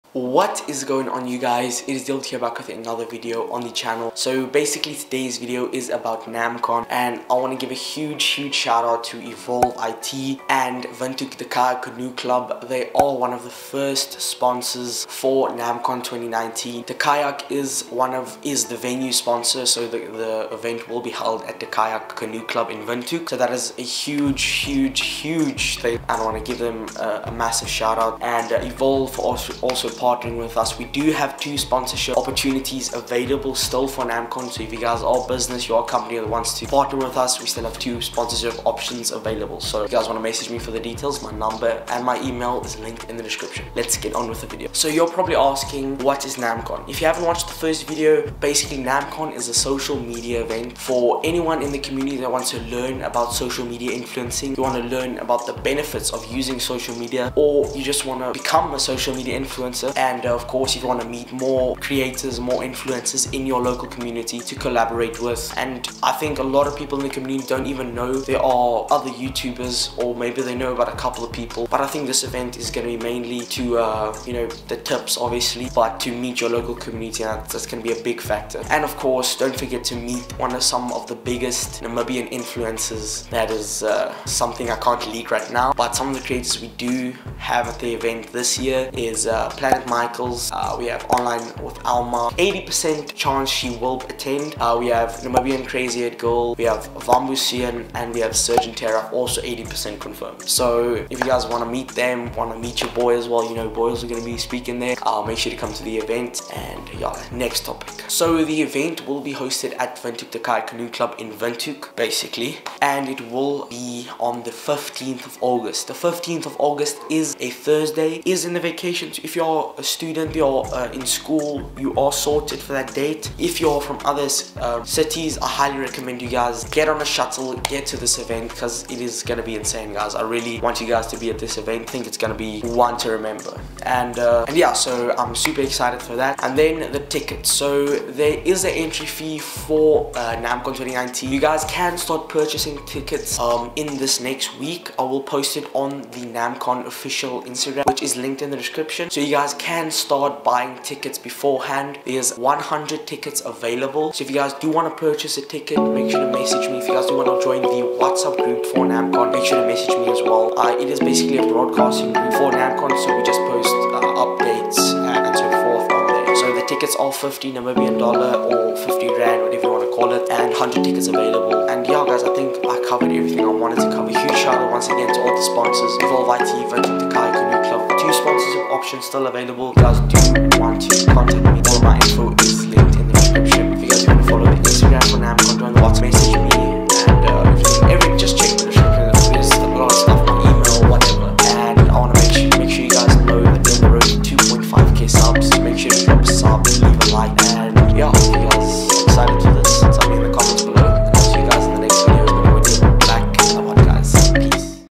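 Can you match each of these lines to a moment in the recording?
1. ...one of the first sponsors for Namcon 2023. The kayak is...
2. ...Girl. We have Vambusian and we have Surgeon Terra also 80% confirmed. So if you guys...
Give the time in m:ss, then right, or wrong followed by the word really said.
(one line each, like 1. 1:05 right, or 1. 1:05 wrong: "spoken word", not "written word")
1. 0:13 wrong: "2019", not "2023"
2. 1:36 right.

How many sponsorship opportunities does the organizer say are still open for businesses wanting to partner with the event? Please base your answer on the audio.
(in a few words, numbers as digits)
2.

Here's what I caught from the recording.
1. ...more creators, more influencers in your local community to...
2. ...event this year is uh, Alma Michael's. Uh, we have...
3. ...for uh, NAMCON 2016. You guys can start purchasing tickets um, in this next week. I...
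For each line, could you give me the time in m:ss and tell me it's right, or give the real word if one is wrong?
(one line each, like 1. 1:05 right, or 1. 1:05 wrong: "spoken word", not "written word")
1. 1:01 right
2. 1:27 wrong: "Planet", not "Alma"
3. 2:19 wrong: "2019", not "2016".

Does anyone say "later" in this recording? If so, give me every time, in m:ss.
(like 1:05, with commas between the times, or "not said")
not said.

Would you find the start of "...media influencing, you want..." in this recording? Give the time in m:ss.
0:53.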